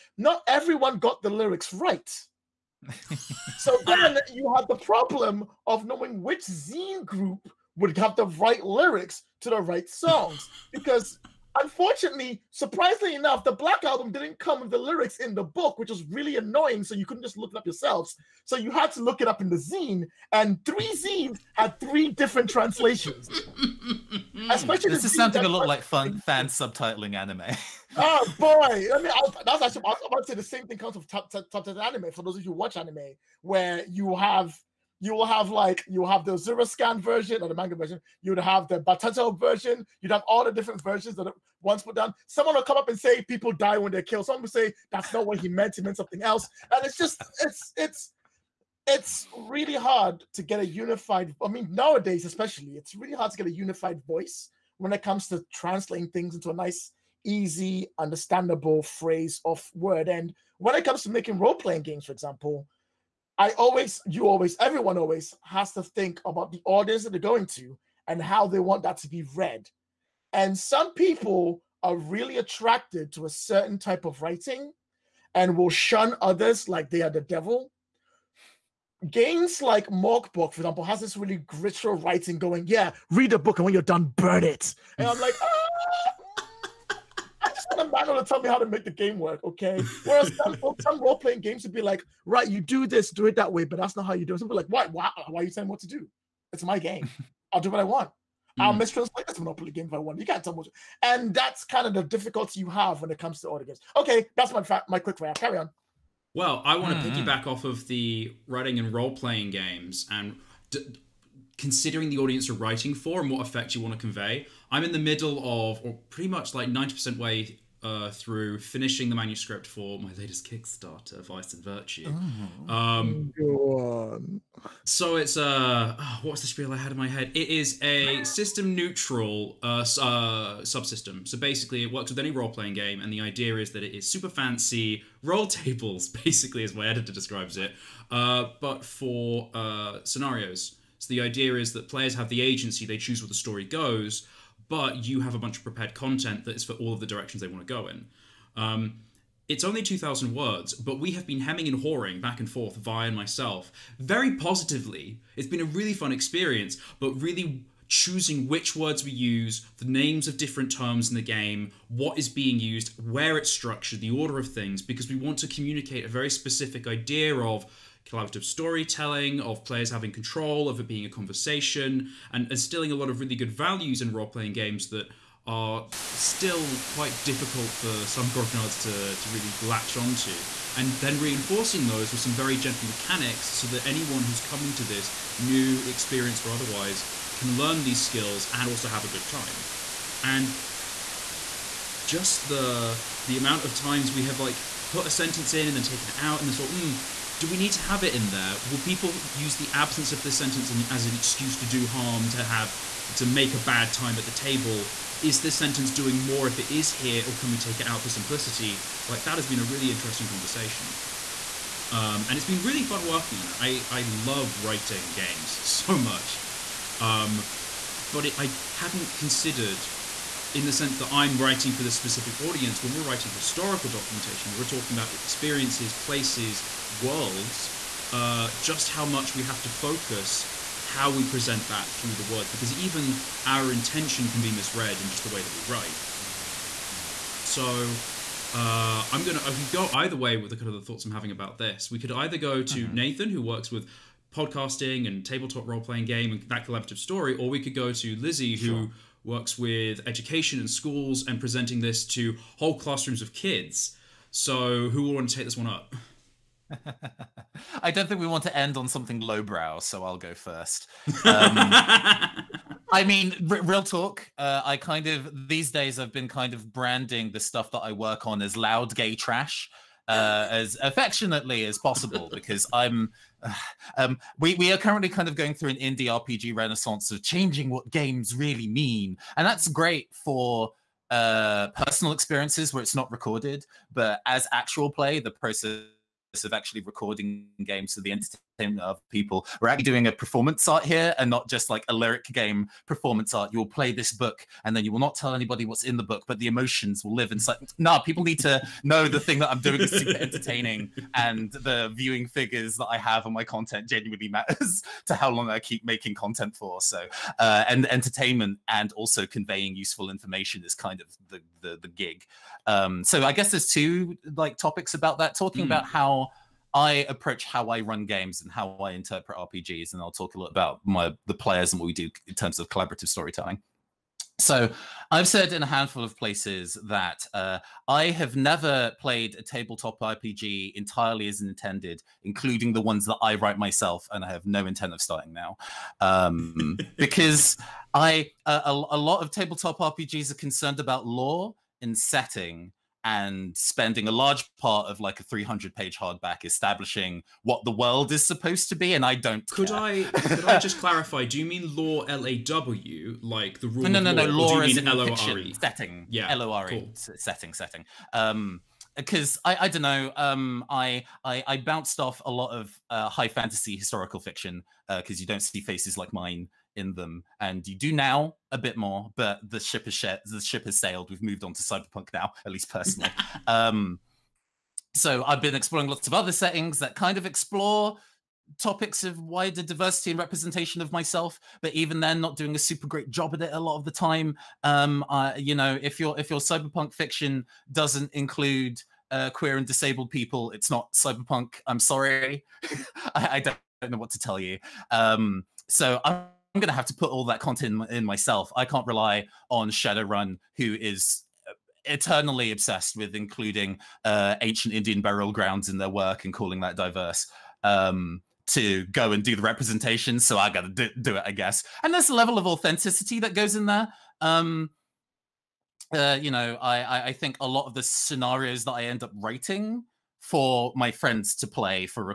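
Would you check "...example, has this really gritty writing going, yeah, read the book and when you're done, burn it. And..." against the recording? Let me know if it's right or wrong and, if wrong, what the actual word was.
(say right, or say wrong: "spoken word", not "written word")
right.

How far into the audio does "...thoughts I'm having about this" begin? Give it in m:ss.
4:00.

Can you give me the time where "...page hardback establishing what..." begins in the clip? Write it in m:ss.
5:45.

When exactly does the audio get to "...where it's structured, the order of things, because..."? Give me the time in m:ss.
2:43.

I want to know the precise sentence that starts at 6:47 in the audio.
Um, to go and do the representation, so I got to do, do, it, I guess.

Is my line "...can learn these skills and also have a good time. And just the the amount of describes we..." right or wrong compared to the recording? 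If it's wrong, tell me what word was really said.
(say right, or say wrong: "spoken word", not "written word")
wrong: "times", not "describes".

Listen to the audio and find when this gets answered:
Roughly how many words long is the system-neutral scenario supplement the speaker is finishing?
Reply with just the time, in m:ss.
2:29.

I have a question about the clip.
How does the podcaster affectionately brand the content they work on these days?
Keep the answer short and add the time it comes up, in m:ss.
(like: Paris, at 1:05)
loud gay trash, at 4:28.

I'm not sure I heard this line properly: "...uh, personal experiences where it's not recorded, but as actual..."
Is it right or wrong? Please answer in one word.
right.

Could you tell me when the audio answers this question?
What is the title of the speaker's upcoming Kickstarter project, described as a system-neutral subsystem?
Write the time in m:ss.
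2:01.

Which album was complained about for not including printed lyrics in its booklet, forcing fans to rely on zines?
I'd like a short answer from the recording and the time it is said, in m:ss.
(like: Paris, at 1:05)
the Black Album, at 0:13.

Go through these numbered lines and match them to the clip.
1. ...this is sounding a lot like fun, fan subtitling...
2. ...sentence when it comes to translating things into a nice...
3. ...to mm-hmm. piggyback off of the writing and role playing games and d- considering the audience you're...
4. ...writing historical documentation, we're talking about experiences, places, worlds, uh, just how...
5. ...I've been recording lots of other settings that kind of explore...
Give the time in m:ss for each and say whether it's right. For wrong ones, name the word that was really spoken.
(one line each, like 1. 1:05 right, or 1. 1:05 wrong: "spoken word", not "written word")
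1. 0:24 right
2. 0:54 wrong: "voice", not "sentence"
3. 1:47 right
4. 3:43 right
5. 6:15 wrong: "exploring", not "recording".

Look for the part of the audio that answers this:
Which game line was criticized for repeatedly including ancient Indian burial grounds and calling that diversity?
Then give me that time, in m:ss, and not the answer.
6:39.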